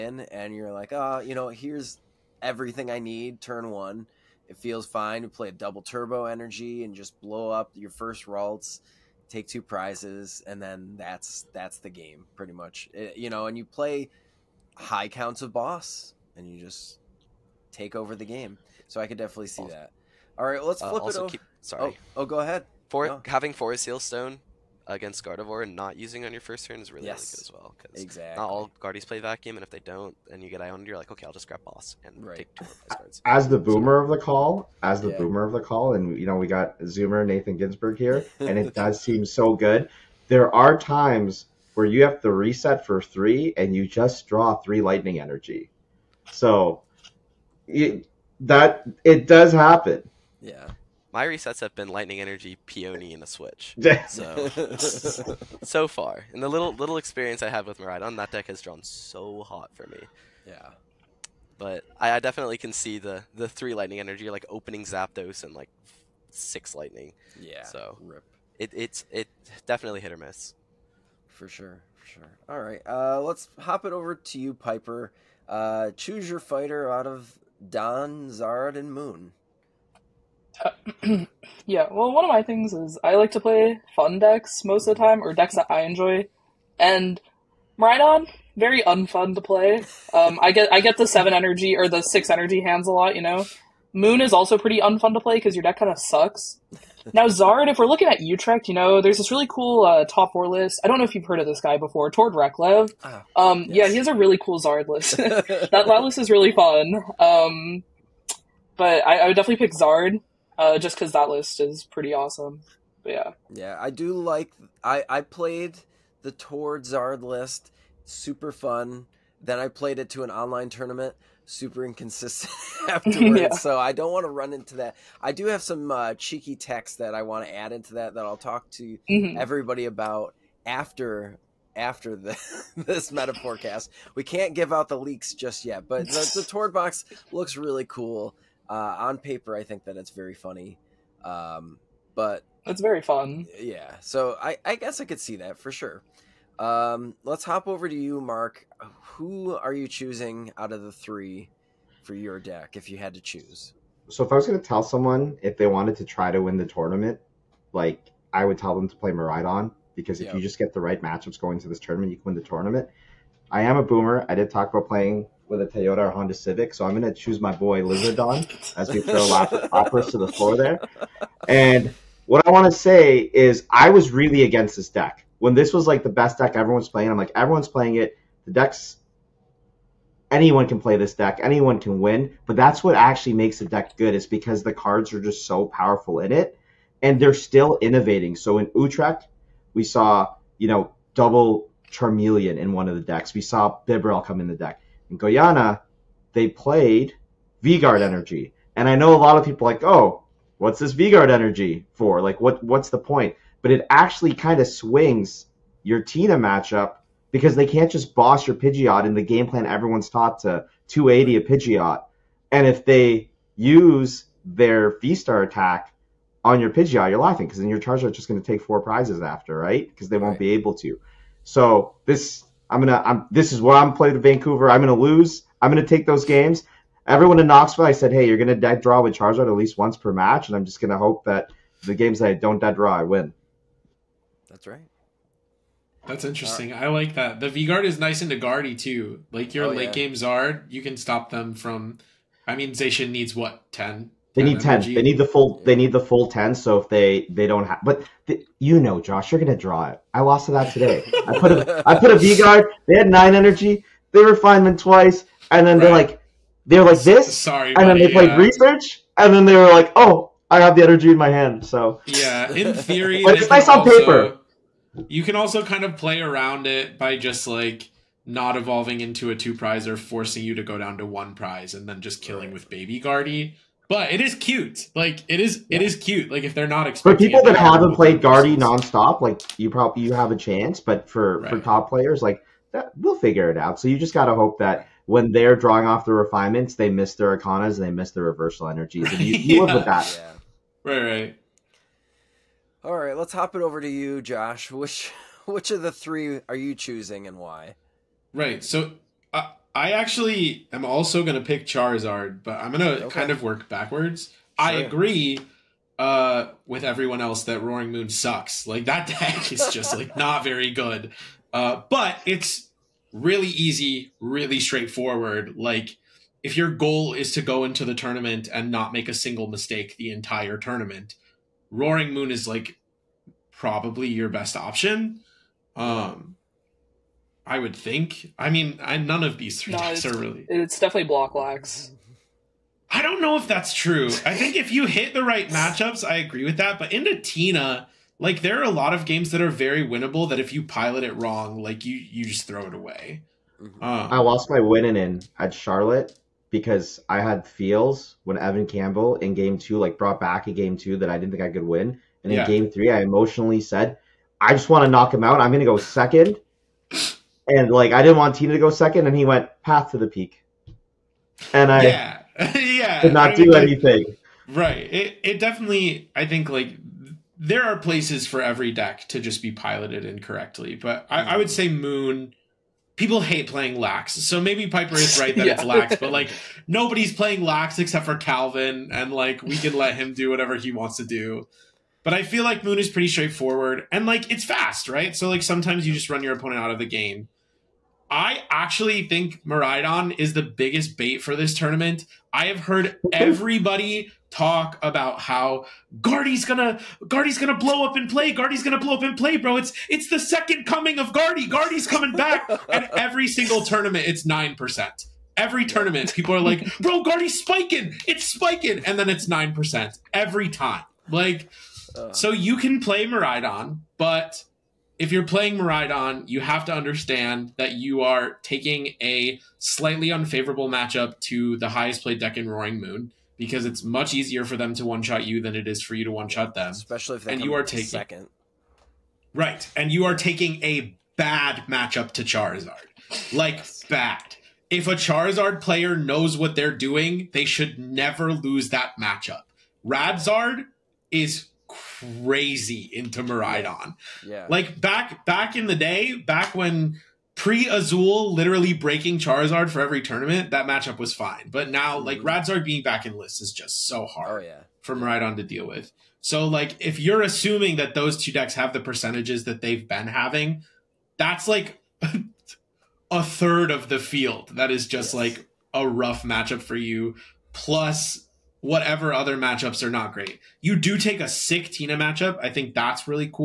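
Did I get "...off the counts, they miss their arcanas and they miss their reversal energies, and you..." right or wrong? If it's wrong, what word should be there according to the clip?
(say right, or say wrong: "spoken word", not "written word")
wrong: "refinements", not "counts".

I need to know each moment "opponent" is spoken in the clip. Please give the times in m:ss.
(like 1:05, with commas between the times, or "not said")
6:26.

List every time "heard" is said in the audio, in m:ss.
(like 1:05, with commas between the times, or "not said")
1:41, 6:32.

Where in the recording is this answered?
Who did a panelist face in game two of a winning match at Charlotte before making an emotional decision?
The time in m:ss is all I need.
5:48.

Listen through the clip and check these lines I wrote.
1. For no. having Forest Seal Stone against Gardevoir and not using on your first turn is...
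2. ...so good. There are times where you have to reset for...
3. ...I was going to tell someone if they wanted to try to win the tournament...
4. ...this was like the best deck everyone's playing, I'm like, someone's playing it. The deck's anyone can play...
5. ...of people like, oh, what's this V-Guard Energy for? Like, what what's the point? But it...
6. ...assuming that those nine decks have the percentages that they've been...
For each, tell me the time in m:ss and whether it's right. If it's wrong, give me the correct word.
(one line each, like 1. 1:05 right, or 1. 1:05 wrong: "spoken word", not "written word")
1. 0:22 right
2. 0:39 right
3. 2:34 right
4. 2:55 wrong: "everyone", not "someone"
5. 3:19 right
6. 7:37 wrong: "two", not "nine".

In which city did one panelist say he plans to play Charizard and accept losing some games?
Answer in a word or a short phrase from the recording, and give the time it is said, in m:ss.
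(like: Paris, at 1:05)
Vancouver, at 3:44.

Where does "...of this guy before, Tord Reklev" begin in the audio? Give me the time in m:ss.
1:41.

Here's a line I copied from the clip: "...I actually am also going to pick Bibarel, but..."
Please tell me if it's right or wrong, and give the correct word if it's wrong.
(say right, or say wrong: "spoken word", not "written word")
wrong: "Charizard", not "Bibarel".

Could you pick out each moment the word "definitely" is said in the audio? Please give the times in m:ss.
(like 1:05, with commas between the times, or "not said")
0:19, 1:02, 1:09, 1:49, 5:30, 6:05.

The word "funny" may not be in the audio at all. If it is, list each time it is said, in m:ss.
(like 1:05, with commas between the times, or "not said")
2:20.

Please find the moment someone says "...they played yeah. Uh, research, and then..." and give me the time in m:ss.
4:18.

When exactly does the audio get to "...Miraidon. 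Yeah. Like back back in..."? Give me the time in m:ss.
7:23.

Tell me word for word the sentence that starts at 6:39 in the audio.
It's it's the second coming of Guardy.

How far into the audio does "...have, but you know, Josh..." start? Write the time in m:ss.
4:07.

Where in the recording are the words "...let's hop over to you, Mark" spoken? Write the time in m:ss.
2:27.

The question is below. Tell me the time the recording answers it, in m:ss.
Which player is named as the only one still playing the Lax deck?
6:18.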